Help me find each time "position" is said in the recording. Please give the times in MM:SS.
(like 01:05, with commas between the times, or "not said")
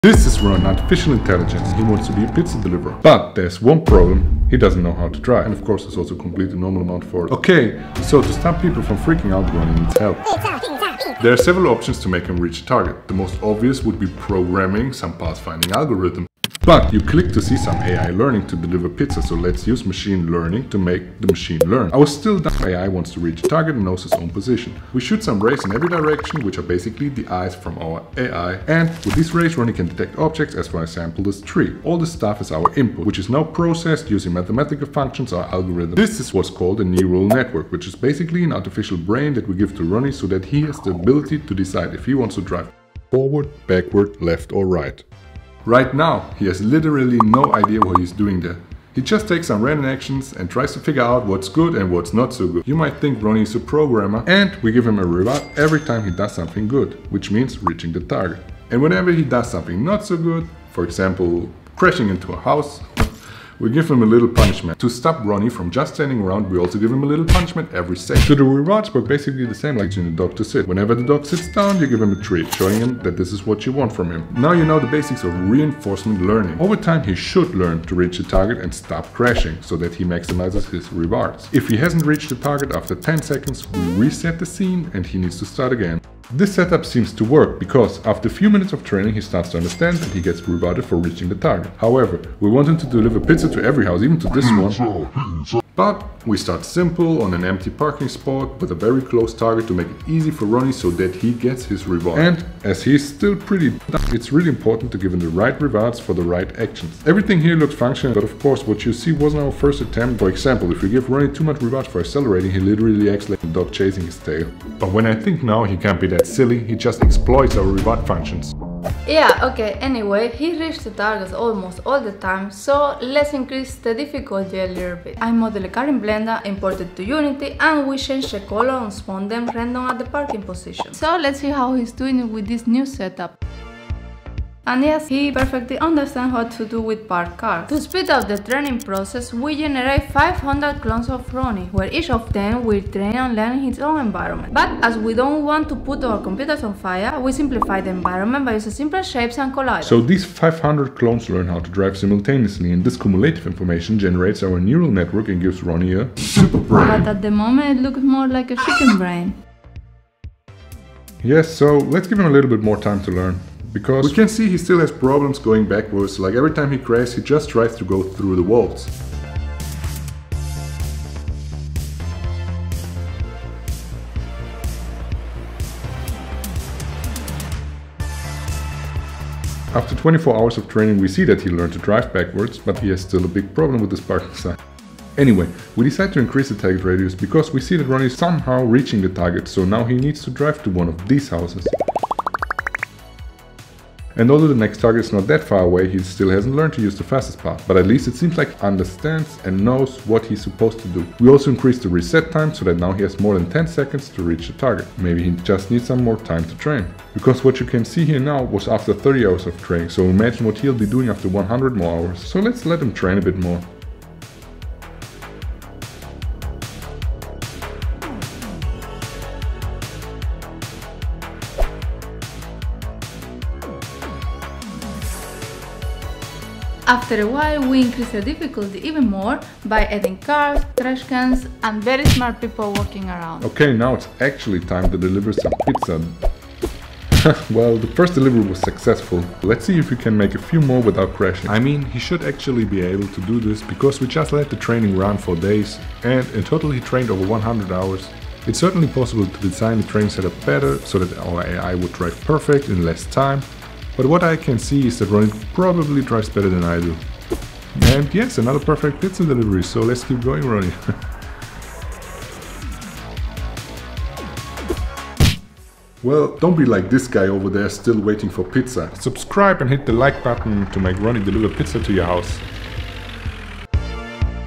00:24, 02:10.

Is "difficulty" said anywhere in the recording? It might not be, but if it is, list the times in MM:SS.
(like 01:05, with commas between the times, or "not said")
02:03, 03:48.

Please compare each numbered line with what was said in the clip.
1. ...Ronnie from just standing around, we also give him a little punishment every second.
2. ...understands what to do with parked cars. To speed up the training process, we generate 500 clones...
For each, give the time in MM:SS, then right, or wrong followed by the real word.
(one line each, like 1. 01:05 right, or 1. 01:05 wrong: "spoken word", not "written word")
1. 01:05 right
2. 02:15 right.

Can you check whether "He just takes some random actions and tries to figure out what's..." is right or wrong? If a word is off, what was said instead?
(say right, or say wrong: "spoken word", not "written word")
right.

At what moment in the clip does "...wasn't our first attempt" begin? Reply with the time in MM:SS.
01:49.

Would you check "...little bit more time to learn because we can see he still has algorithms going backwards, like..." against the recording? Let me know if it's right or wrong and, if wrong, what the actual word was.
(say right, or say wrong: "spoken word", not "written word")
wrong: "problems", not "algorithms".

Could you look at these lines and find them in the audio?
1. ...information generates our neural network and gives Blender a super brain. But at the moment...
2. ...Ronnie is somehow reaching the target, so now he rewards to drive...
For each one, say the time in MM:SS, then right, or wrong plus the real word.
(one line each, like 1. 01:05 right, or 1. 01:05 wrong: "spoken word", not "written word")
1. 02:33 wrong: "Ronnie", not "Blender"
2. 03:07 wrong: "needs", not "rewards".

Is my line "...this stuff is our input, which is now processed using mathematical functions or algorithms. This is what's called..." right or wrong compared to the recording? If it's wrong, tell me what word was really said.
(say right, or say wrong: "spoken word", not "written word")
right.